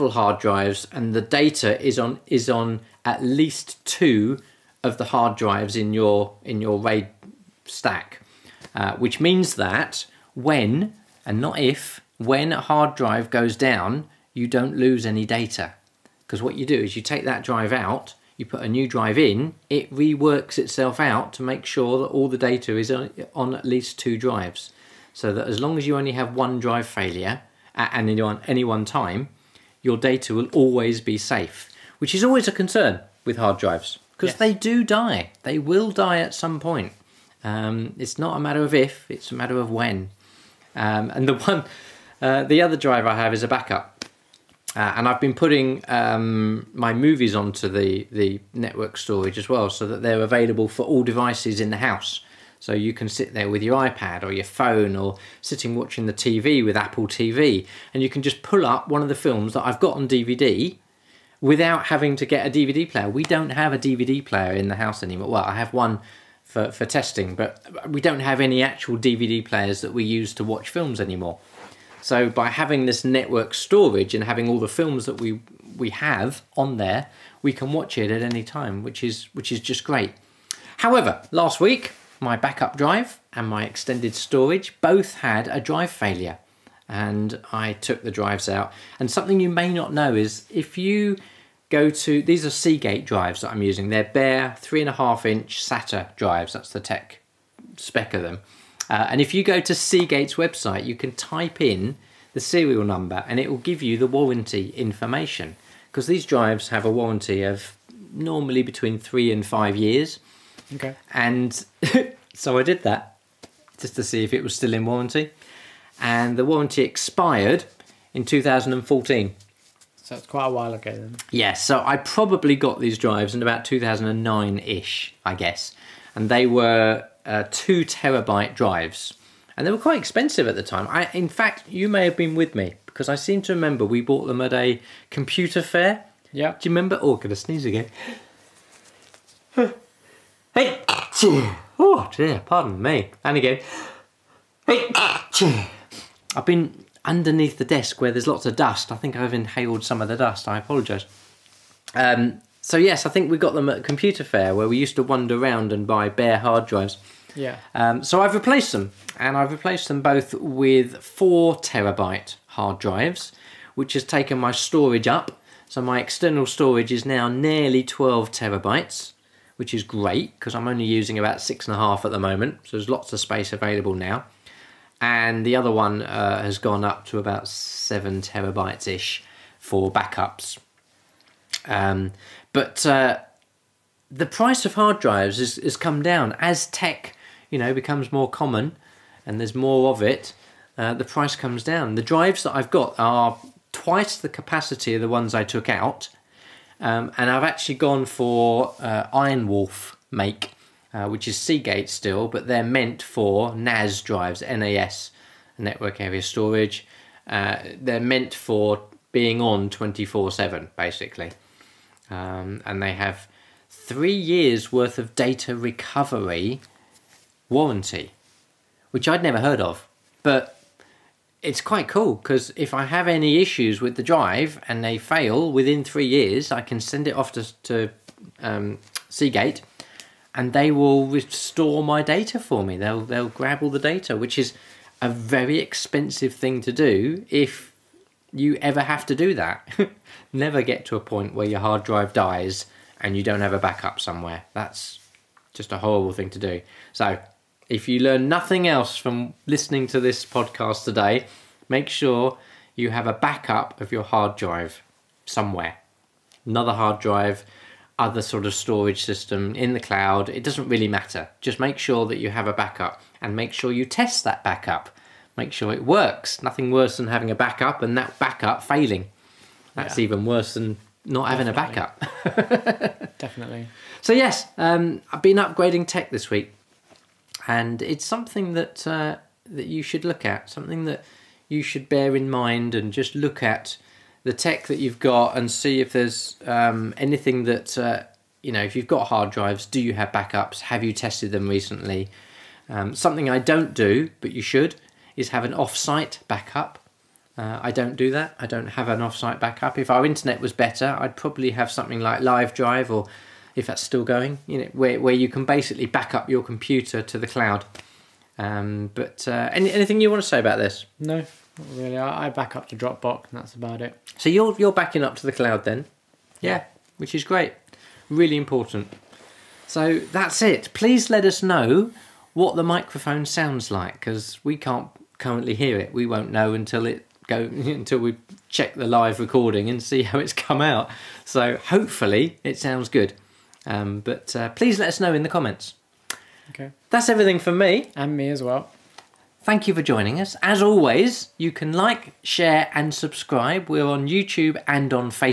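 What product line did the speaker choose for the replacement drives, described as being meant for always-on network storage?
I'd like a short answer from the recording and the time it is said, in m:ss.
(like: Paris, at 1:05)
IronWolf, at 3:19.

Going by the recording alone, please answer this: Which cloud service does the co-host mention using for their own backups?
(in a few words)
Dropbox.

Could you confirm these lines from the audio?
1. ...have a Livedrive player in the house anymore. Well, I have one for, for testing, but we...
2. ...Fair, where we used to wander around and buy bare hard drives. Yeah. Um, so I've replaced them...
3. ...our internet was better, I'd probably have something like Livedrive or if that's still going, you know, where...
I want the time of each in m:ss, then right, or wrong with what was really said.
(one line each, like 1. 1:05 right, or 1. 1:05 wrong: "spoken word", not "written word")
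1. 1:03 wrong: "DVD", not "Livedrive"
2. 2:34 right
3. 4:59 right.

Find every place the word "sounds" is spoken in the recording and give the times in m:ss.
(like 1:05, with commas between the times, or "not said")
5:23, 5:32.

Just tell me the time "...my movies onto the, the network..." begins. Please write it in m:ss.
0:46.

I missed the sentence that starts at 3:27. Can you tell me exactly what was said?
Uh, they're meant for being on 24 7 basically.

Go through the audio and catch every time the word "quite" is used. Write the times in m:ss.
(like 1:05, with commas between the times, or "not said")
2:00, 2:09, 3:41.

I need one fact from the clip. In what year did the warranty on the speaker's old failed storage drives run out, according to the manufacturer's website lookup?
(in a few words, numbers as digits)
2014.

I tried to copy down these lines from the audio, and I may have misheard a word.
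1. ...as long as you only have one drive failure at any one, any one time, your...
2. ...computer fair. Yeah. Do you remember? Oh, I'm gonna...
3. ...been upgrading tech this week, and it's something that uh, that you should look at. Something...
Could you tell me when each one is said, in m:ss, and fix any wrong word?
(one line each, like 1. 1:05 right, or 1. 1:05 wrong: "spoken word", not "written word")
1. 0:25 right
2. 2:15 right
3. 4:35 right.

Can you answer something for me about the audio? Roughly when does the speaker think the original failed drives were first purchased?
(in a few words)
2009.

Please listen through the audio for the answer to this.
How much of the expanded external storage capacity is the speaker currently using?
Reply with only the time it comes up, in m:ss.
2:51.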